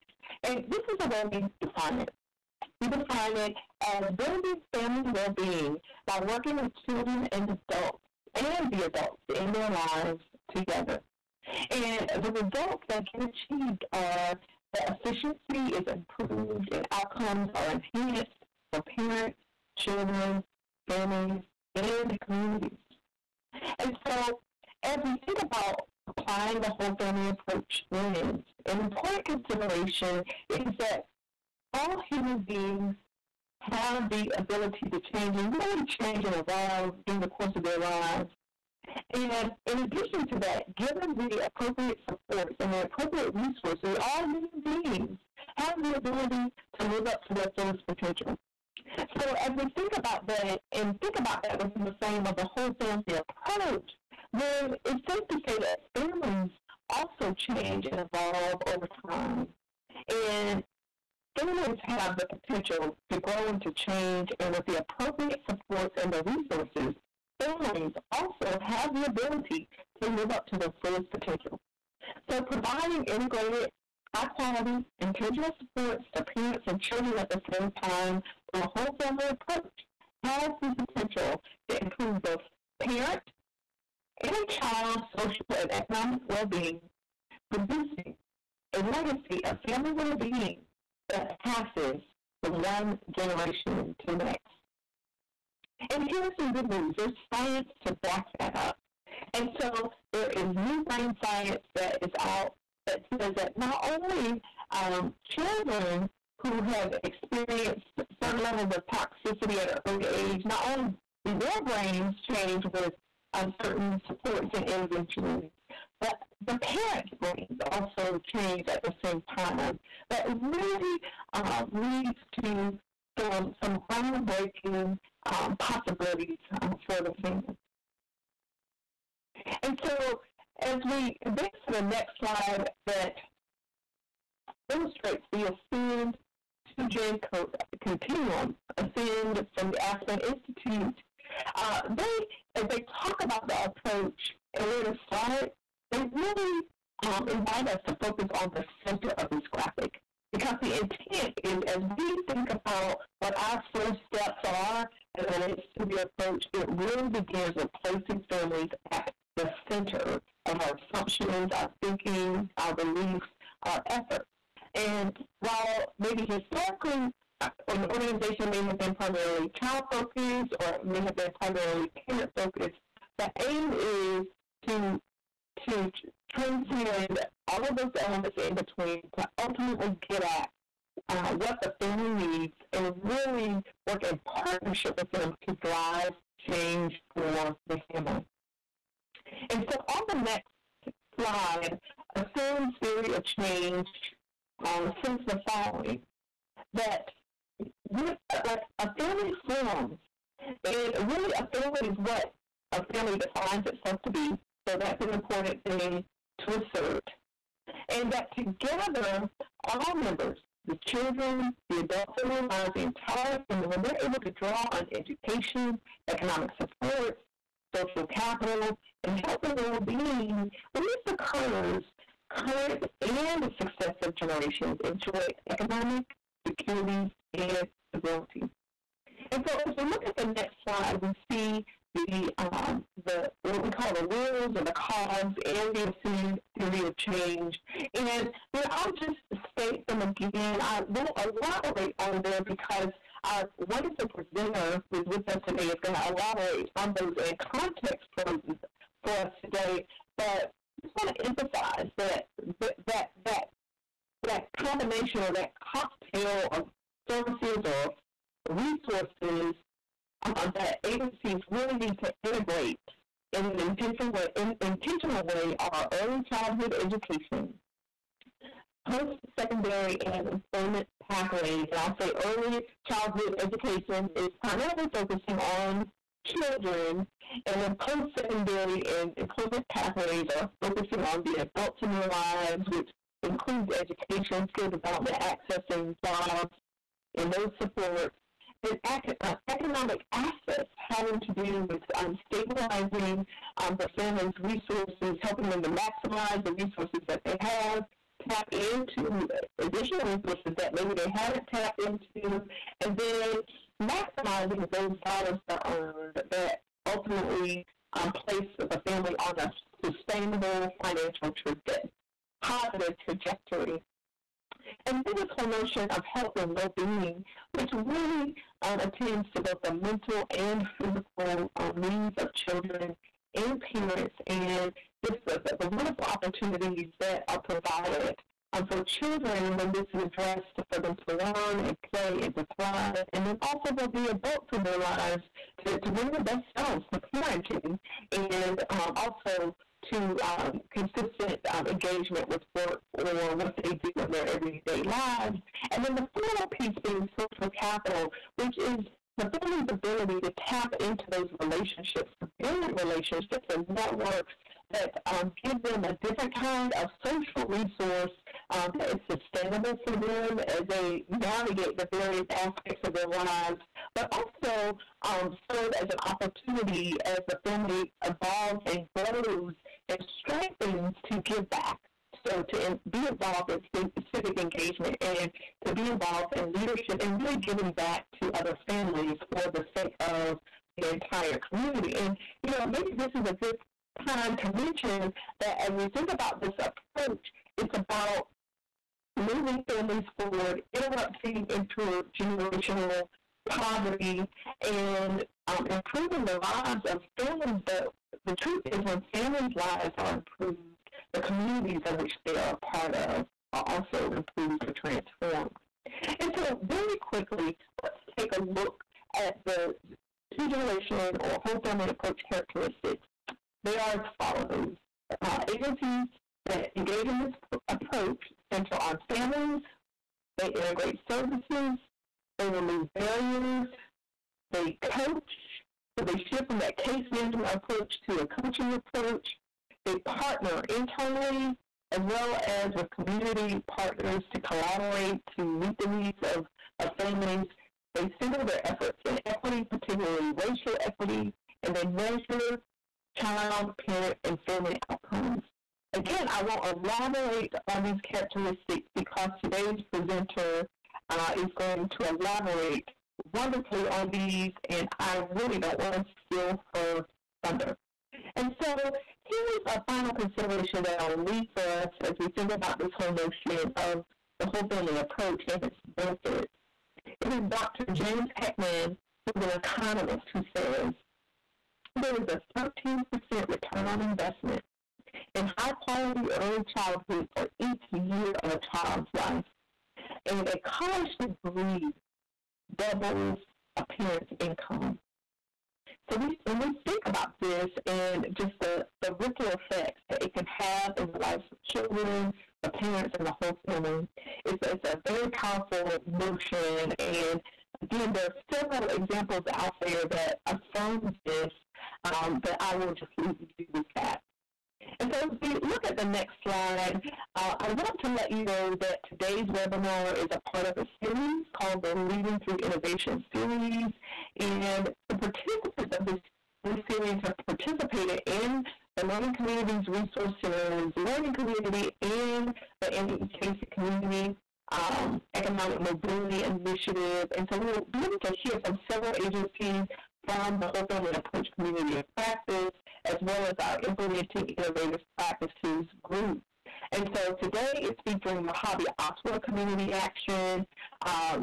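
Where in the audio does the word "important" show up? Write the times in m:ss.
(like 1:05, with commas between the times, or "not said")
0:28, 3:25.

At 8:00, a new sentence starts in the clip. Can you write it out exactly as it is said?
And a college degree doubles a parent's income.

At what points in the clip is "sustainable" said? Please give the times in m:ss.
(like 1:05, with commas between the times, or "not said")
5:09, 5:59.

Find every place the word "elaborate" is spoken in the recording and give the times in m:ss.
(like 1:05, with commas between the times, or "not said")
4:01, 4:06, 7:26, 7:32.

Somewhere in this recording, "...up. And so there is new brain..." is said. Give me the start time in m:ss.
1:38.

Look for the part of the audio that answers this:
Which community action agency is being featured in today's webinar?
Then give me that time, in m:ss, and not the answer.
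8:58.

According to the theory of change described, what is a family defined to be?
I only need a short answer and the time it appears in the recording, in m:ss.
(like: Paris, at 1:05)
what a family defines itself to be, at 3:21.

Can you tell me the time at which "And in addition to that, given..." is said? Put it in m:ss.
0:39.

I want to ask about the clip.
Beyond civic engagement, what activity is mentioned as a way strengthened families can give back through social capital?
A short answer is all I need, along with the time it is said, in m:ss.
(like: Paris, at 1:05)
leadership, at 6:16.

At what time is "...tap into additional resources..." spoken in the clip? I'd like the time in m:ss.
4:58.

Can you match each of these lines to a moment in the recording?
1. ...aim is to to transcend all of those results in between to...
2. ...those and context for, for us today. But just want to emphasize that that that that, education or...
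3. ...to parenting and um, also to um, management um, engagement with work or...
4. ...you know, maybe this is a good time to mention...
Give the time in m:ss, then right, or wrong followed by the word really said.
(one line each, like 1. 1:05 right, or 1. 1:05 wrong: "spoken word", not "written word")
1. 2:53 wrong: "elements", not "results"
2. 4:06 wrong: "combination", not "education"
3. 5:36 wrong: "consistent", not "management"
4. 6:22 right.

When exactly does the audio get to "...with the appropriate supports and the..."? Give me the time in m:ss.
1:04.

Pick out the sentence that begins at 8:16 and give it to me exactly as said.
And again, there are several examples out there that affirm this, um, but I will just leave you with that.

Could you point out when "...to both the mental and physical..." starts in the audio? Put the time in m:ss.
5:19.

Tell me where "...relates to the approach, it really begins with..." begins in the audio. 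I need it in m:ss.
2:35.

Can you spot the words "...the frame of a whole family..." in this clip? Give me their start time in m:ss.
0:51.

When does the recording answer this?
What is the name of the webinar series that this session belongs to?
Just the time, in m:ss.
8:31.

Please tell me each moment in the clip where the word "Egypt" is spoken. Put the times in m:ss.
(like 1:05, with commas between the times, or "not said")
not said.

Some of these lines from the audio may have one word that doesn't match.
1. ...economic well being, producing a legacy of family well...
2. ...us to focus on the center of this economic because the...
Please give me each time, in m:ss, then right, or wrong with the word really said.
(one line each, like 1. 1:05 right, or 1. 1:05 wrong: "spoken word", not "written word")
1. 1:25 right
2. 2:27 wrong: "graphic", not "economic".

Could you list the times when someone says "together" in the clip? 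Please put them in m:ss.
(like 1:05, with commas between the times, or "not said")
0:10, 3:28.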